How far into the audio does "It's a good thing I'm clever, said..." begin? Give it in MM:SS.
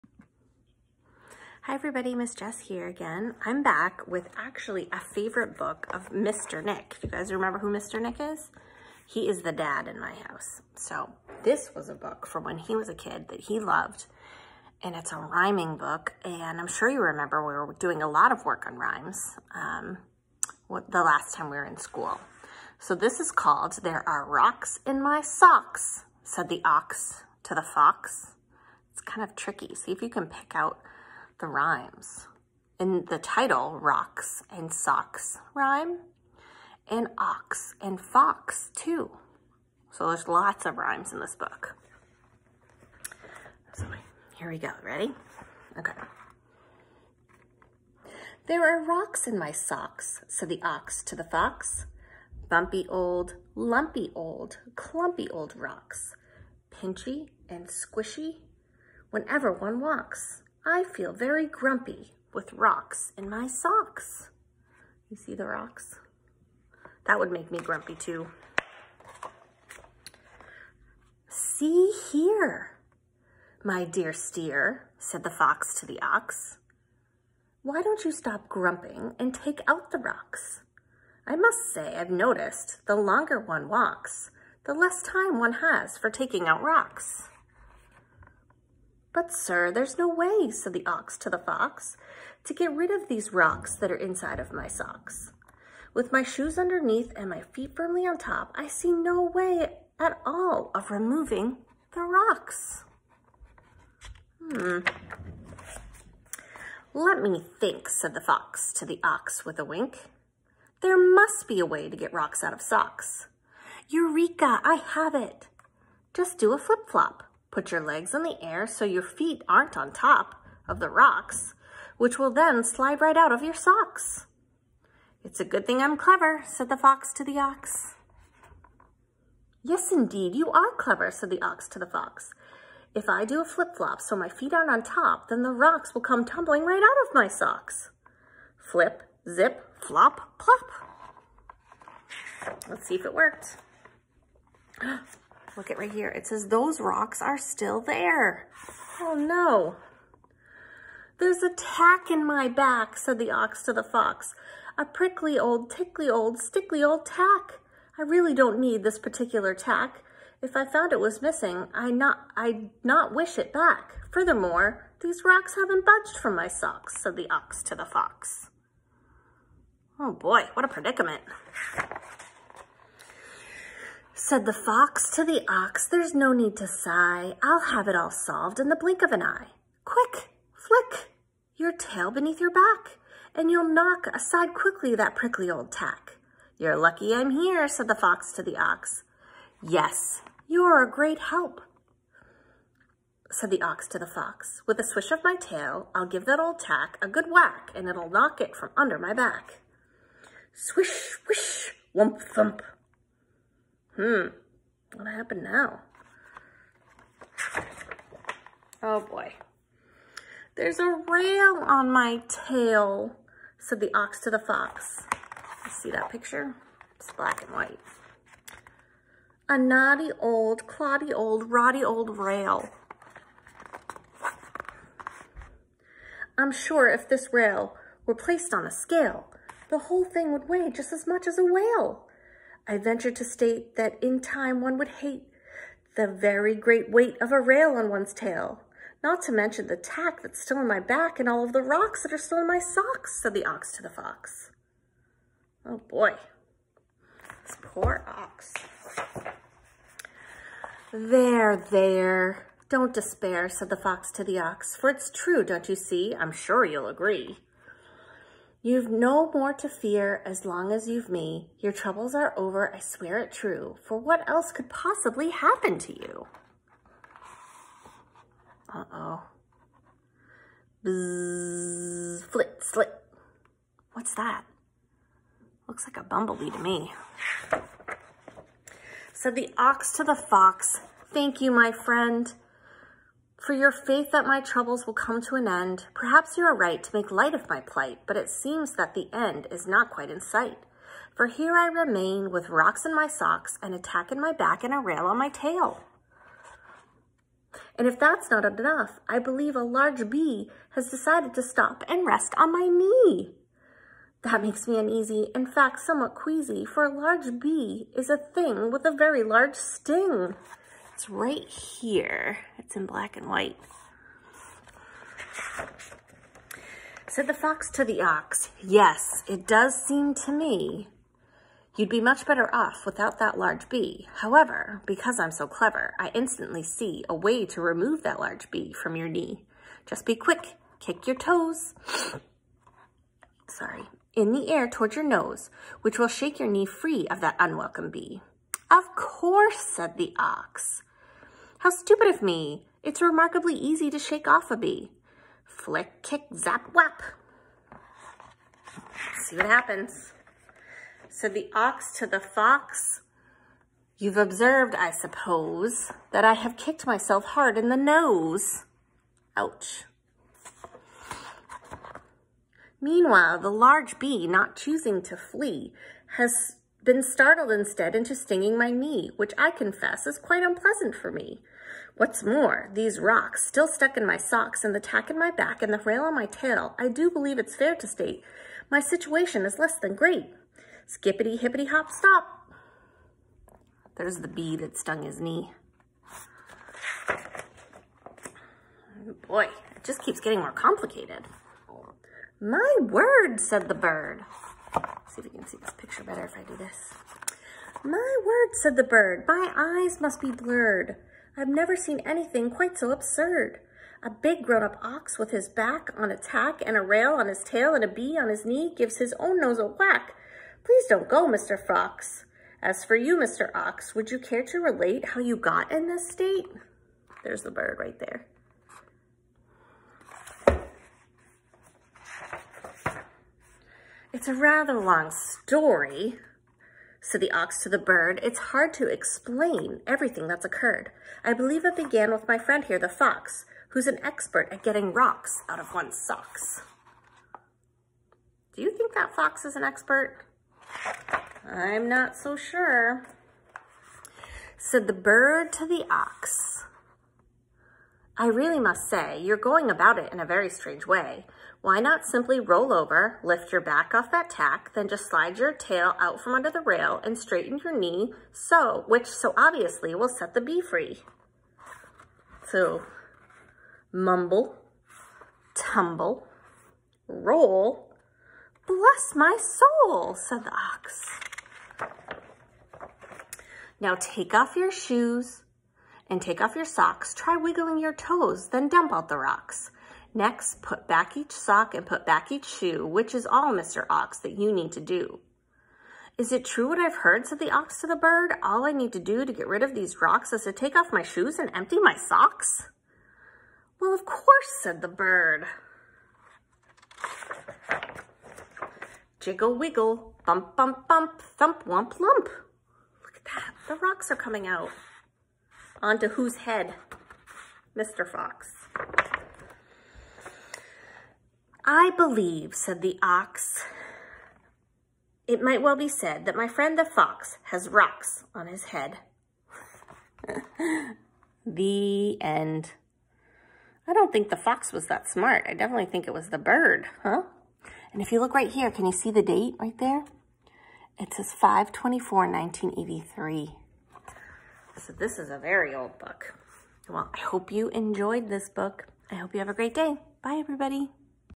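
02:05.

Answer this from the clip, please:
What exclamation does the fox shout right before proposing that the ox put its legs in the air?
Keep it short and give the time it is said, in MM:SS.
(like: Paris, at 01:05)
Eureka, at 01:53.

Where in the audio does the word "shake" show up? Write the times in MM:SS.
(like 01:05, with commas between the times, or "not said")
05:36, 05:43.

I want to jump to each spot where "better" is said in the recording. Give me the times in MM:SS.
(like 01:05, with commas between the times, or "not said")
05:22, 06:36.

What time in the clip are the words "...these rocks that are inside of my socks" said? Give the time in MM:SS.
01:33.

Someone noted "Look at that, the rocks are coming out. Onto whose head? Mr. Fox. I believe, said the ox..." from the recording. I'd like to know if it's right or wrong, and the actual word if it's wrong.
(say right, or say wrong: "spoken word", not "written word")
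right.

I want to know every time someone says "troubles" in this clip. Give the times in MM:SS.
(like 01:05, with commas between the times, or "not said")
04:21, 04:44.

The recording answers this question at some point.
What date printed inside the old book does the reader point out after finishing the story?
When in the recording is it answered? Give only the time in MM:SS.
08:51.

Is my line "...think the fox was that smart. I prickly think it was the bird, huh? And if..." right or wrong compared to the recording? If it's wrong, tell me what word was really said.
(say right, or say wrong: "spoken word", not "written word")
wrong: "definitely", not "prickly".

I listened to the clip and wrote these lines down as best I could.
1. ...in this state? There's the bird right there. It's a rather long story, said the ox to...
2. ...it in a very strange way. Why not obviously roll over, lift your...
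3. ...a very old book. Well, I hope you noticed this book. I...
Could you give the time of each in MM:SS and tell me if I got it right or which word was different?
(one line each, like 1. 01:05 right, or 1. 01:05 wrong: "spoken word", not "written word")
1. 06:55 right
2. 07:29 wrong: "simply", not "obviously"
3. 08:55 wrong: "enjoyed", not "noticed".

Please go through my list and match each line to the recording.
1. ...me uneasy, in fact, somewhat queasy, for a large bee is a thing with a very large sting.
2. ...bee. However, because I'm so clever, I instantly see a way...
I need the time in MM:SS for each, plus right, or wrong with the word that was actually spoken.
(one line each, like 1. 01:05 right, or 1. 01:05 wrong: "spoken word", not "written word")
1. 05:04 right
2. 05:23 right.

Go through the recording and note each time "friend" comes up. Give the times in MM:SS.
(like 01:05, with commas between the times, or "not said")
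04:41, 07:12, 08:36.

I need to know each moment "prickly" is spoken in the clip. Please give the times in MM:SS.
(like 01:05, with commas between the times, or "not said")
02:34, 03:05.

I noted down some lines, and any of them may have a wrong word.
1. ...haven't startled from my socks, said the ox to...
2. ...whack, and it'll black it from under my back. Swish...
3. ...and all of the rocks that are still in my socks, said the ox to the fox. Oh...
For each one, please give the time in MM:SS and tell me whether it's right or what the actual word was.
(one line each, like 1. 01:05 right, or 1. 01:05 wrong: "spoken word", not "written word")
1. 02:45 wrong: "budged", not "startled"
2. 03:17 wrong: "knock", not "black"
3. 04:01 right.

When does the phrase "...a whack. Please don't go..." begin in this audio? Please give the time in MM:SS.
06:49.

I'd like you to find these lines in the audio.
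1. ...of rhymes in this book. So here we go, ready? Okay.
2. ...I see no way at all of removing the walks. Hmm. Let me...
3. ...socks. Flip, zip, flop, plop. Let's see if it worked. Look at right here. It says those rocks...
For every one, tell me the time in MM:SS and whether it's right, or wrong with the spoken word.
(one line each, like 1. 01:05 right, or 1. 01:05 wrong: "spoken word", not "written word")
1. 00:40 right
2. 01:38 wrong: "rocks", not "walks"
3. 02:17 right.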